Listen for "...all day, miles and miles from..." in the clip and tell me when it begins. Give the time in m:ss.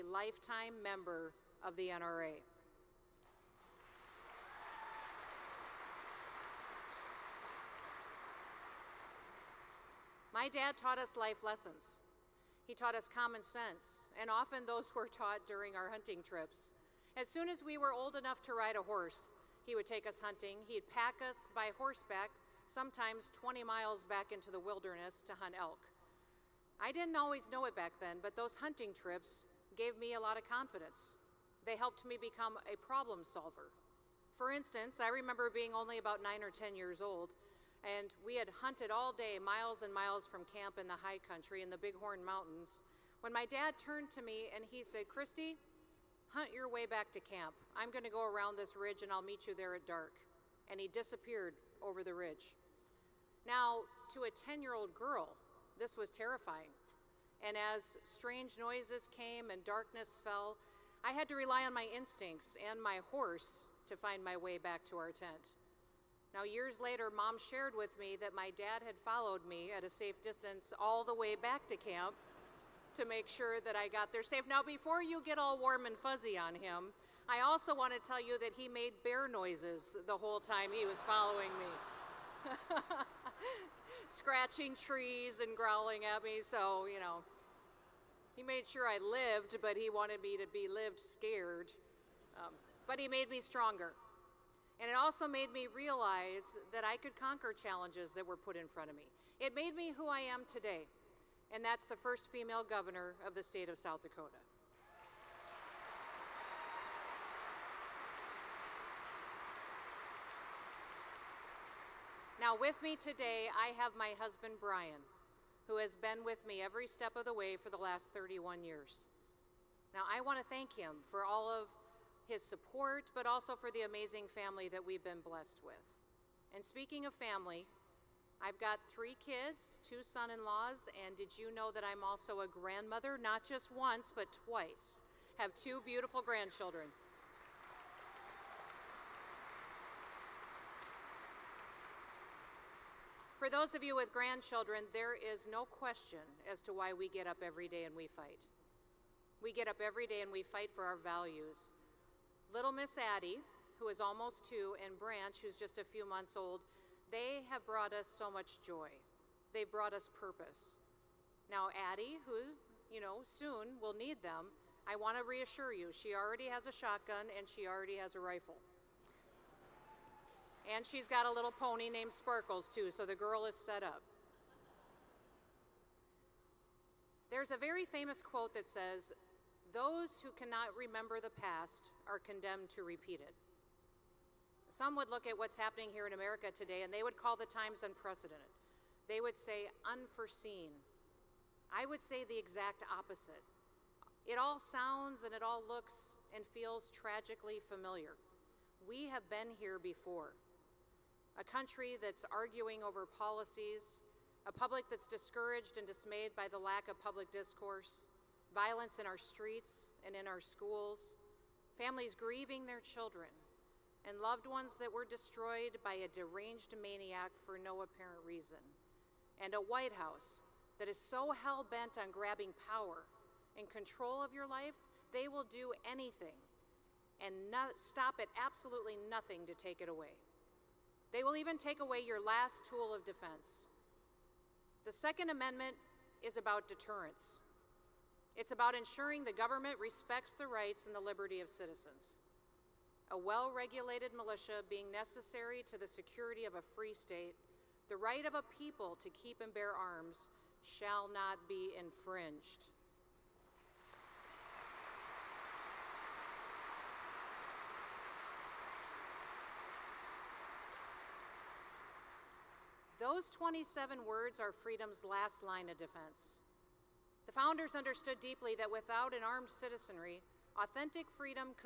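0:38.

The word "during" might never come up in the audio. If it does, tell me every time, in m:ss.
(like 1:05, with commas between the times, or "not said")
0:15.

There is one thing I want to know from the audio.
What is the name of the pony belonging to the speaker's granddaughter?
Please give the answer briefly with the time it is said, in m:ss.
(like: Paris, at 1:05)
Sparkles, at 2:52.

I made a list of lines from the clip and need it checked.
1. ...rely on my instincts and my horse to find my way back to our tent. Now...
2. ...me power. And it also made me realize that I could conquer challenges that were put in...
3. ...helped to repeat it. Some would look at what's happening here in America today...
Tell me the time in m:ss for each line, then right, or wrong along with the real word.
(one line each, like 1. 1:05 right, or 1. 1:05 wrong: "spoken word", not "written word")
1. 1:01 right
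2. 1:33 wrong: "stronger", not "power"
3. 3:02 wrong: "condemned", not "helped".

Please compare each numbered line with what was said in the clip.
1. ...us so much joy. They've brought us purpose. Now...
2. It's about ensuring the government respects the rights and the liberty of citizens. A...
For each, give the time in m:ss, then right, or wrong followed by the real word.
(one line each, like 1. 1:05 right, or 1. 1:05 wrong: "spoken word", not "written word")
1. 2:37 right
2. 3:58 right.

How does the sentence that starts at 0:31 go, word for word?
They helped me become a problem solver.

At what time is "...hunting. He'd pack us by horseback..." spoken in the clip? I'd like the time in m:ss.
0:20.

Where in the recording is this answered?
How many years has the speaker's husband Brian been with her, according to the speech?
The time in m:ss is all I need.
1:58.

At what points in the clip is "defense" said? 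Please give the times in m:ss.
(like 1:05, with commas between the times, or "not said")
3:53, 4:25.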